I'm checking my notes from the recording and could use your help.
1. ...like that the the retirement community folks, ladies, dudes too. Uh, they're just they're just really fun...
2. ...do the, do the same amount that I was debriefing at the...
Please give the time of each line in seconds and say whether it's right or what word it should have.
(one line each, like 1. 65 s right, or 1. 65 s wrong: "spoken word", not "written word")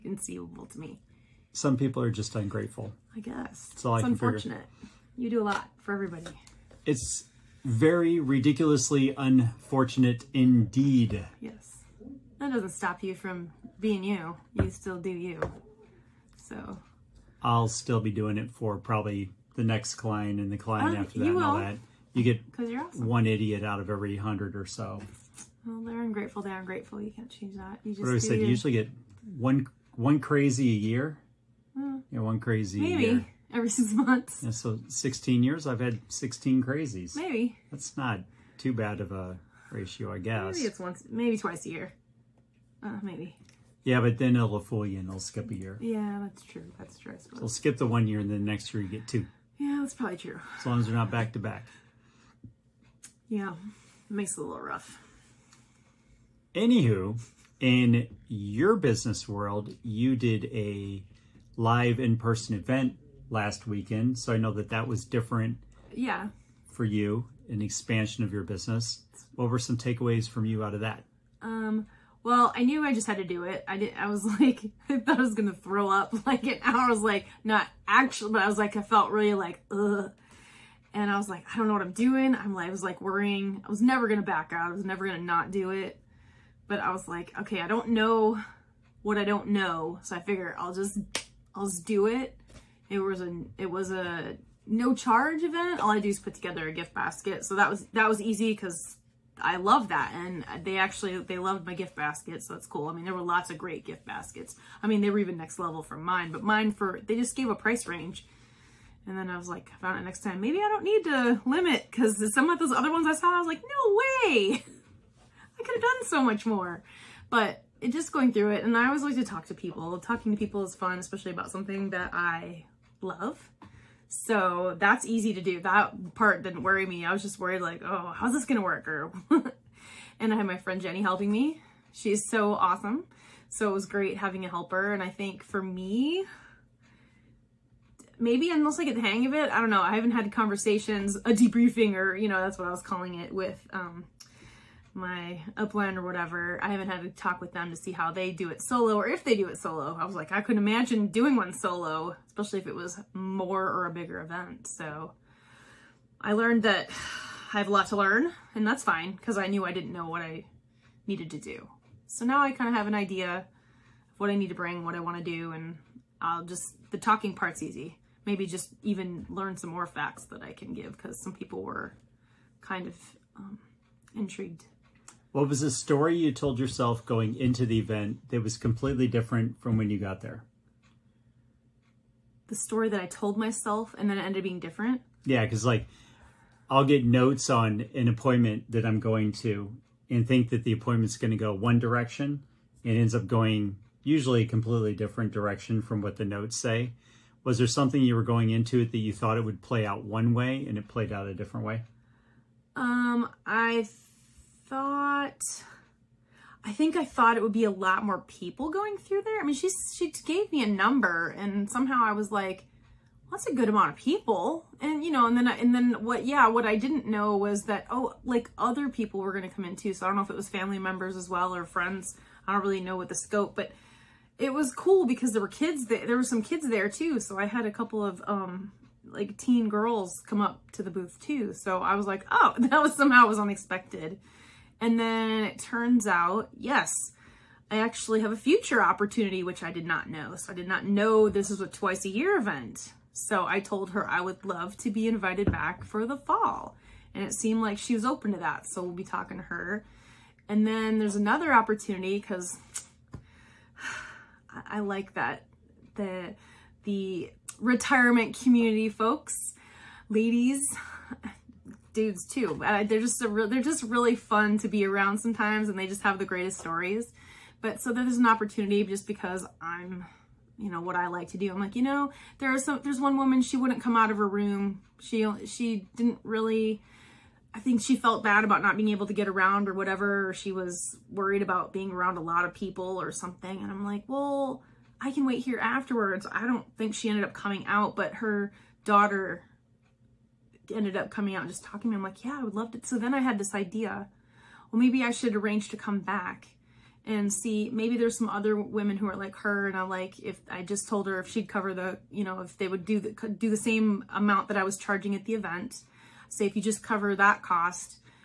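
1. 254 s right
2. 302 s wrong: "charging", not "debriefing".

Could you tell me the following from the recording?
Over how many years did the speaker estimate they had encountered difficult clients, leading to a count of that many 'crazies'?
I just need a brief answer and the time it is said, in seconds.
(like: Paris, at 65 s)
16, at 34 s.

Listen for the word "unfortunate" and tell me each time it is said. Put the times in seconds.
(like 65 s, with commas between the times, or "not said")
4 s, 9 s.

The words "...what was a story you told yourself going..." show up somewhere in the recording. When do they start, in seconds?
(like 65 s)
175 s.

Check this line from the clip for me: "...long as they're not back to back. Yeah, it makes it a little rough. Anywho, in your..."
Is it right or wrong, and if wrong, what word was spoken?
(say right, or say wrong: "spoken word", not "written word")
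right.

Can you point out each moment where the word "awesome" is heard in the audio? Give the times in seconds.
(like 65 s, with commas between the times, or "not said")
22 s, 132 s.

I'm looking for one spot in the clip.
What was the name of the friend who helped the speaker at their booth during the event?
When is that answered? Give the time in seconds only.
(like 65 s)
130 s.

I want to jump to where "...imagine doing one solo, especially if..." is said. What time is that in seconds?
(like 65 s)
150 s.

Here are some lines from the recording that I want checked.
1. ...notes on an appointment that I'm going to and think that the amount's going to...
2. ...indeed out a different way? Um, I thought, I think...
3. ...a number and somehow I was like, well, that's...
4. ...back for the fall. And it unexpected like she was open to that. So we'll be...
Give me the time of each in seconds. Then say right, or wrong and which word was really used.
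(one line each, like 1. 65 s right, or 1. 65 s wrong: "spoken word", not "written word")
1. 187 s wrong: "appointment", not "amount"
2. 200 s wrong: "played", not "indeed"
3. 210 s right
4. 245 s wrong: "seemed", not "unexpected".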